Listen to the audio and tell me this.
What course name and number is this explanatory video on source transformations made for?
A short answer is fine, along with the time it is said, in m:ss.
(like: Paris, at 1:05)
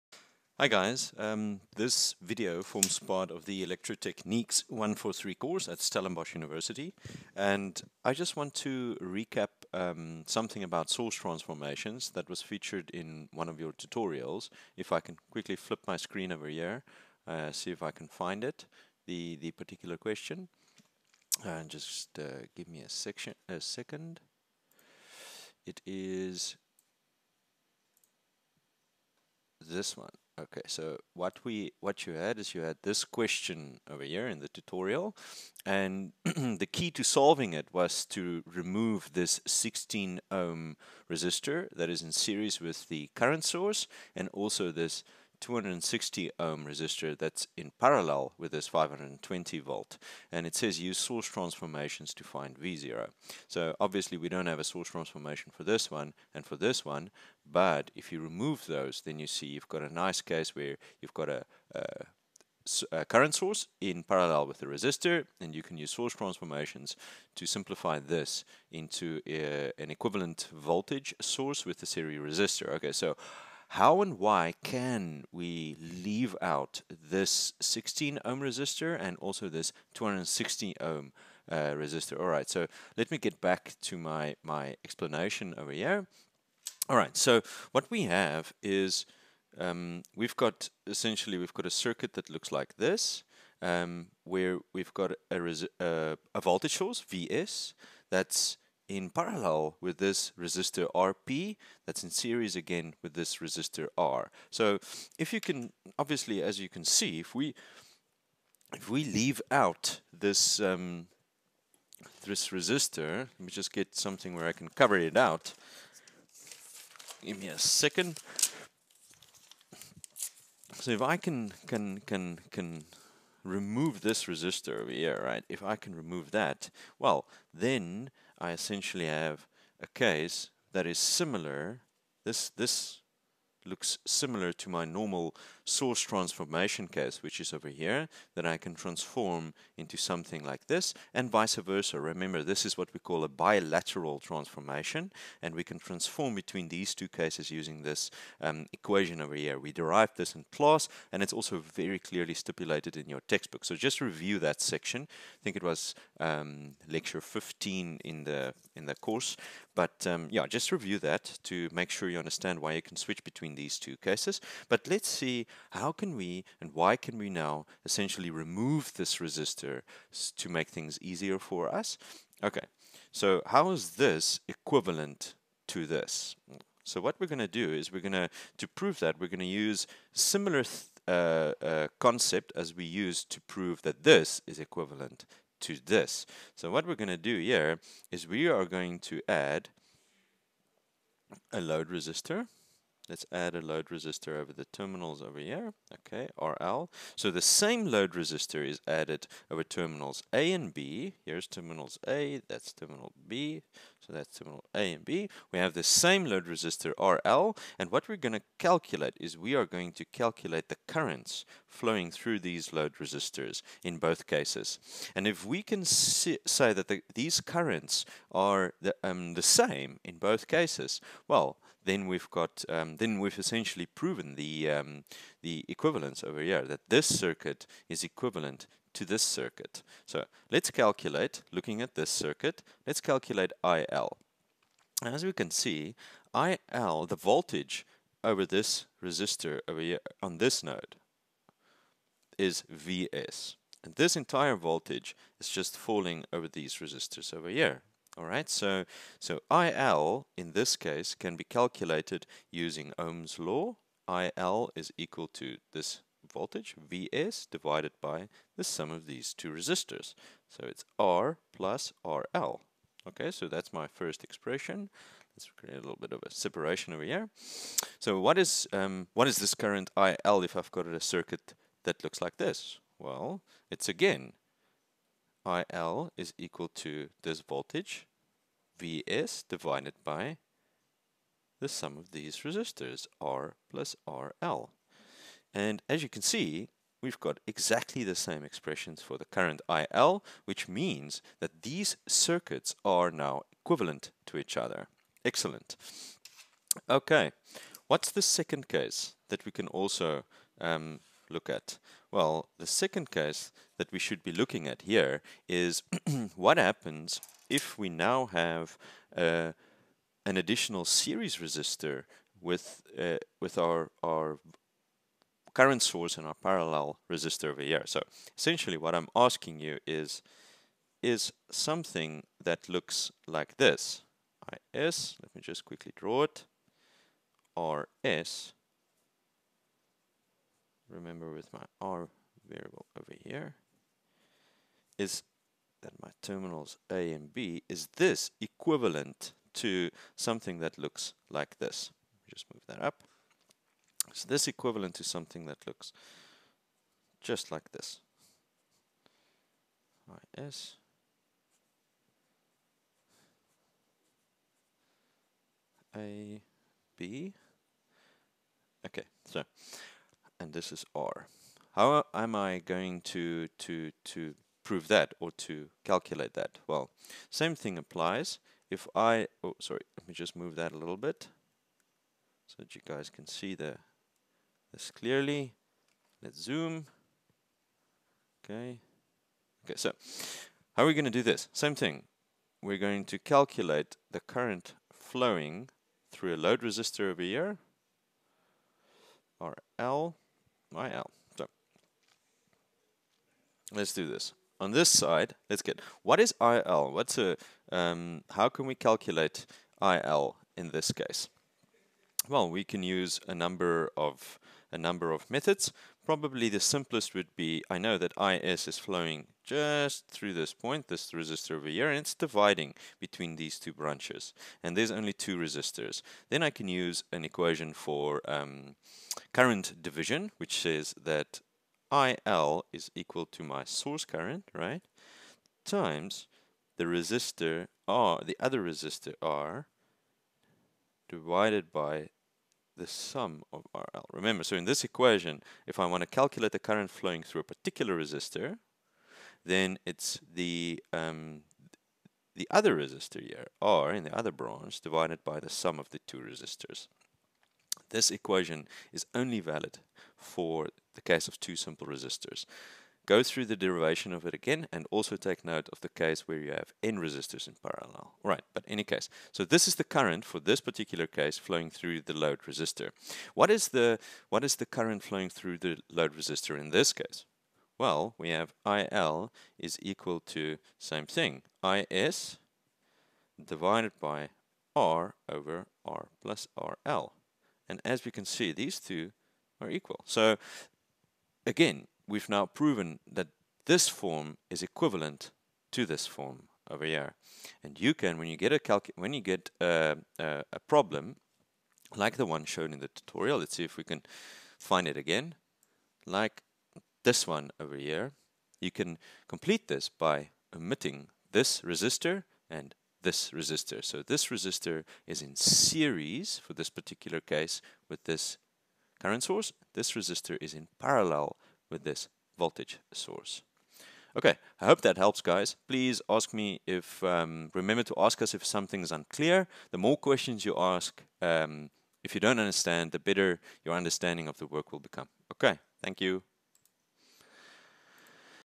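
Electrotechniques 143, at 0:03.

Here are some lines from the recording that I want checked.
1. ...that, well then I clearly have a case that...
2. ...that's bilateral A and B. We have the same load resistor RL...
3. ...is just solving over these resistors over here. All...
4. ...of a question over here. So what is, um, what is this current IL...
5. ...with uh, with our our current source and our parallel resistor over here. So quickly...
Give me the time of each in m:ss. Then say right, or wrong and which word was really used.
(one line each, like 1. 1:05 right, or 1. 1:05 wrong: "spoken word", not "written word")
1. 2:06 wrong: "essentially", not "clearly"
2. 3:24 wrong: "terminal", not "bilateral"
3. 4:05 wrong: "falling", not "solving"
4. 4:26 wrong: "separation", not "question"
5. 5:12 wrong: "essentially", not "quickly".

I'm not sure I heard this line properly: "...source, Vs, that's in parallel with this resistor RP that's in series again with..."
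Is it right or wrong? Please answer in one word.
right.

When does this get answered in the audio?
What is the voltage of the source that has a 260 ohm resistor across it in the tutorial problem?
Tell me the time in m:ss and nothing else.
0:48.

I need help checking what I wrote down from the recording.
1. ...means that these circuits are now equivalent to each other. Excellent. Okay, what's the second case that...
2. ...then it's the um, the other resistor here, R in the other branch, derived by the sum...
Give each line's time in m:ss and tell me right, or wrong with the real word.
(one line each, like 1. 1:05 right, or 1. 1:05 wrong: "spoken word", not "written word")
1. 4:50 right
2. 7:19 wrong: "divided", not "derived".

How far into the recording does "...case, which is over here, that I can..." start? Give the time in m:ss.
2:16.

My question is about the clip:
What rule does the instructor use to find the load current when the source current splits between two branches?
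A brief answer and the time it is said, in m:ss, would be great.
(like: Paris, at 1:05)
current division, at 6:59.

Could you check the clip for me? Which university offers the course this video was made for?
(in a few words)
Stellenbosch University.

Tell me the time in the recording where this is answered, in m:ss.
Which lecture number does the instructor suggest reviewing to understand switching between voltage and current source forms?
2:36.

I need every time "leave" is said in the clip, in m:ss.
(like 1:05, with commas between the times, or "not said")
1:15, 1:49.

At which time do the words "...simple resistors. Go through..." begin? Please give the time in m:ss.
7:31.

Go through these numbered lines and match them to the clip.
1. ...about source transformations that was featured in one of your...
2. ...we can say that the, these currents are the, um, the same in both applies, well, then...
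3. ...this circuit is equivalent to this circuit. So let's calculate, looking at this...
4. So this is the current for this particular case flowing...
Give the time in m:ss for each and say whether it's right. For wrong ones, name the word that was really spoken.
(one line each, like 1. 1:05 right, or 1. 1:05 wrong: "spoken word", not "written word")
1. 0:10 right
2. 3:35 wrong: "cases", not "applies"
3. 3:46 right
4. 7:39 right.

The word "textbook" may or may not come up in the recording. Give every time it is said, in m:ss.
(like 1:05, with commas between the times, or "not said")
2:33.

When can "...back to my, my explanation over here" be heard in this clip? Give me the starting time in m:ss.
1:23.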